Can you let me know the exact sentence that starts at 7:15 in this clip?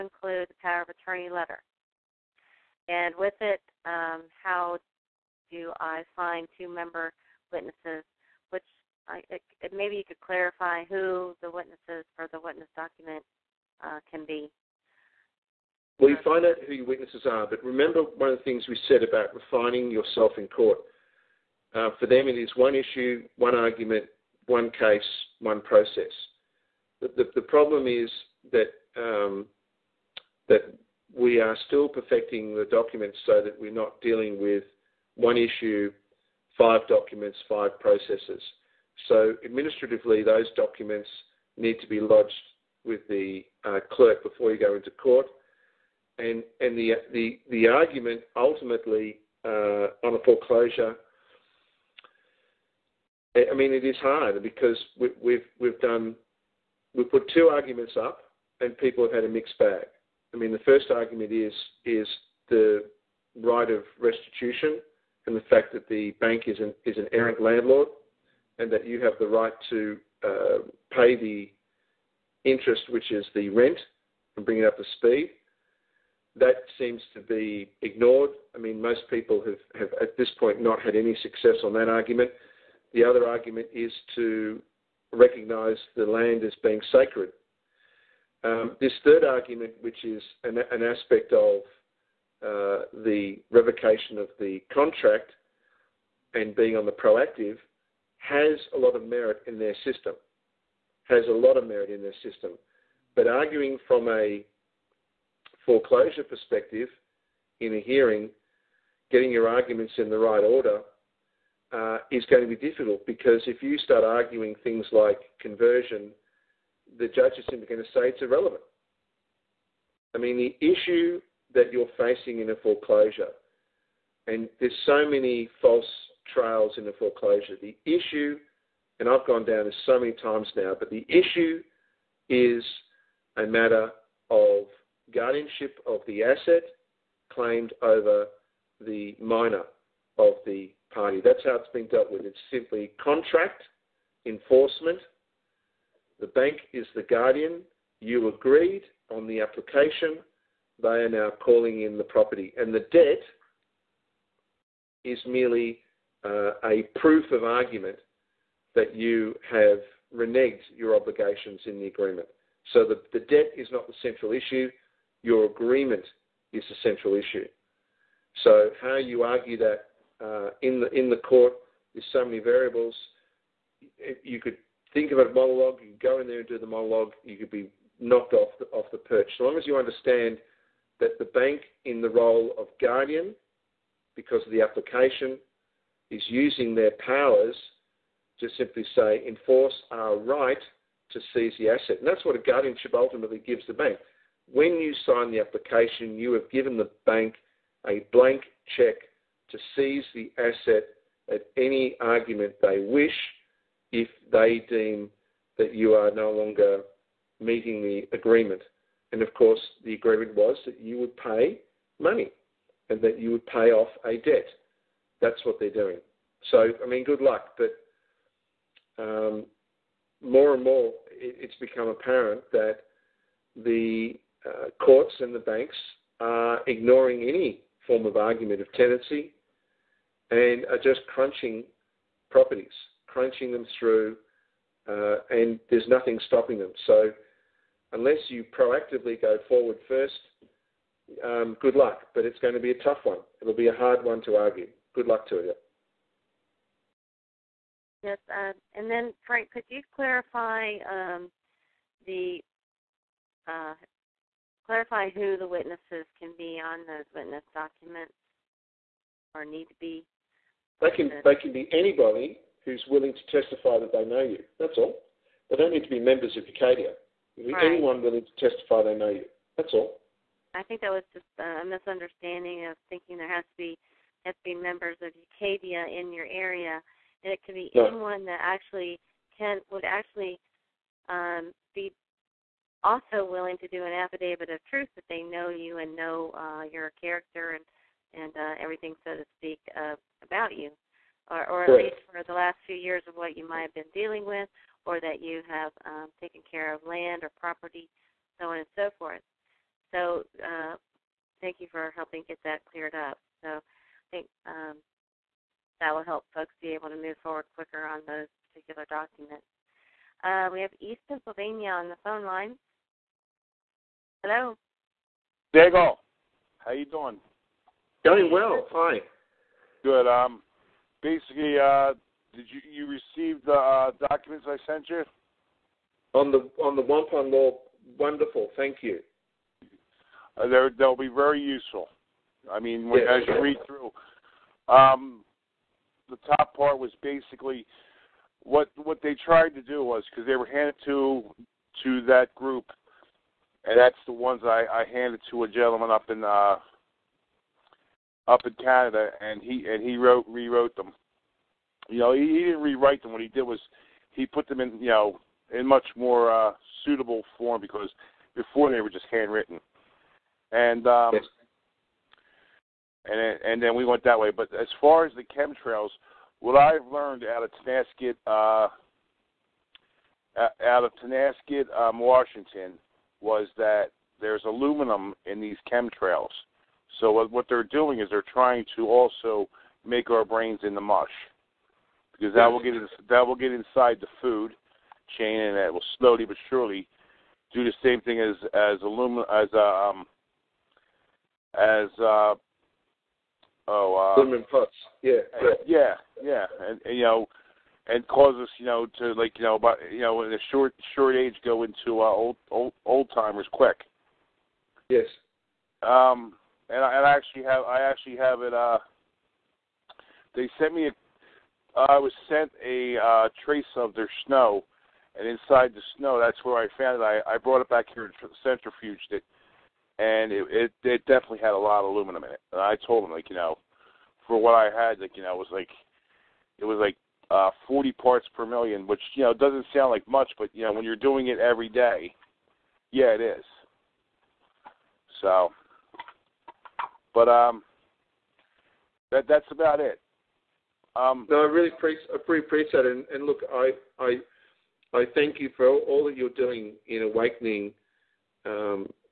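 So, but um, that that's about it.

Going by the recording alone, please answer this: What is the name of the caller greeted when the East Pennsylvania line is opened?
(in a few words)
Diego.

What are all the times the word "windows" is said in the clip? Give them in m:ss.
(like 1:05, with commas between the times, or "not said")
not said.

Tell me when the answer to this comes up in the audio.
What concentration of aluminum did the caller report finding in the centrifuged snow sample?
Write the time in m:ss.
7:07.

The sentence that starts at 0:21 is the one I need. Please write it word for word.
Uh, for them, it is one issue, one argument, one case, one process.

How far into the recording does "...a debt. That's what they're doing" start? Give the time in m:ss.
3:34.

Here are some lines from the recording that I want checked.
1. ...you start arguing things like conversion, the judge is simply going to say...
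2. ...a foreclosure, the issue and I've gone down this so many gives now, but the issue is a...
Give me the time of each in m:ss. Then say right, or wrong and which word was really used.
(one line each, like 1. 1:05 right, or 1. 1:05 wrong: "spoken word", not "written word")
1. 1:53 right
2. 2:06 wrong: "times", not "gives".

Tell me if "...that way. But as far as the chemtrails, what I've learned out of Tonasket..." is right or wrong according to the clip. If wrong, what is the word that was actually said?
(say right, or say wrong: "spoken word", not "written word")
right.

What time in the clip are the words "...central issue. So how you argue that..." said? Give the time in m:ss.
2:46.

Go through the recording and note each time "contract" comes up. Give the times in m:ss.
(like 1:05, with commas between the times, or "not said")
1:34, 2:23.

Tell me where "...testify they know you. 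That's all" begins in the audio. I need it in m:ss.
4:28.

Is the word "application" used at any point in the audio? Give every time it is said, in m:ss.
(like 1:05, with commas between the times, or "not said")
2:29, 3:04, 3:15.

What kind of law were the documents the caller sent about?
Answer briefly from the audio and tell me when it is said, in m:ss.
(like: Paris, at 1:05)
Wampum law, at 5:26.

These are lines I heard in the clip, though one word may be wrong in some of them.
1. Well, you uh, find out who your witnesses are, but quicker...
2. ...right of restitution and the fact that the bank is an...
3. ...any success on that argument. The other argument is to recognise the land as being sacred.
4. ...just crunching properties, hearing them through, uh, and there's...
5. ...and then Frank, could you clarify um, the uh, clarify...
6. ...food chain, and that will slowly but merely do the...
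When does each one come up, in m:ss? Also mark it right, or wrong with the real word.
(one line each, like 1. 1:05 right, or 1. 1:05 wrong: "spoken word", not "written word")
1. 0:15 wrong: "remember", not "quicker"
2. 1:03 right
3. 1:20 right
4. 3:50 wrong: "crunching", not "hearing"
5. 4:08 right
6. 6:24 wrong: "surely", not "merely".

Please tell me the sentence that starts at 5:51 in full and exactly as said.
You know, he, he didn't rewrite them.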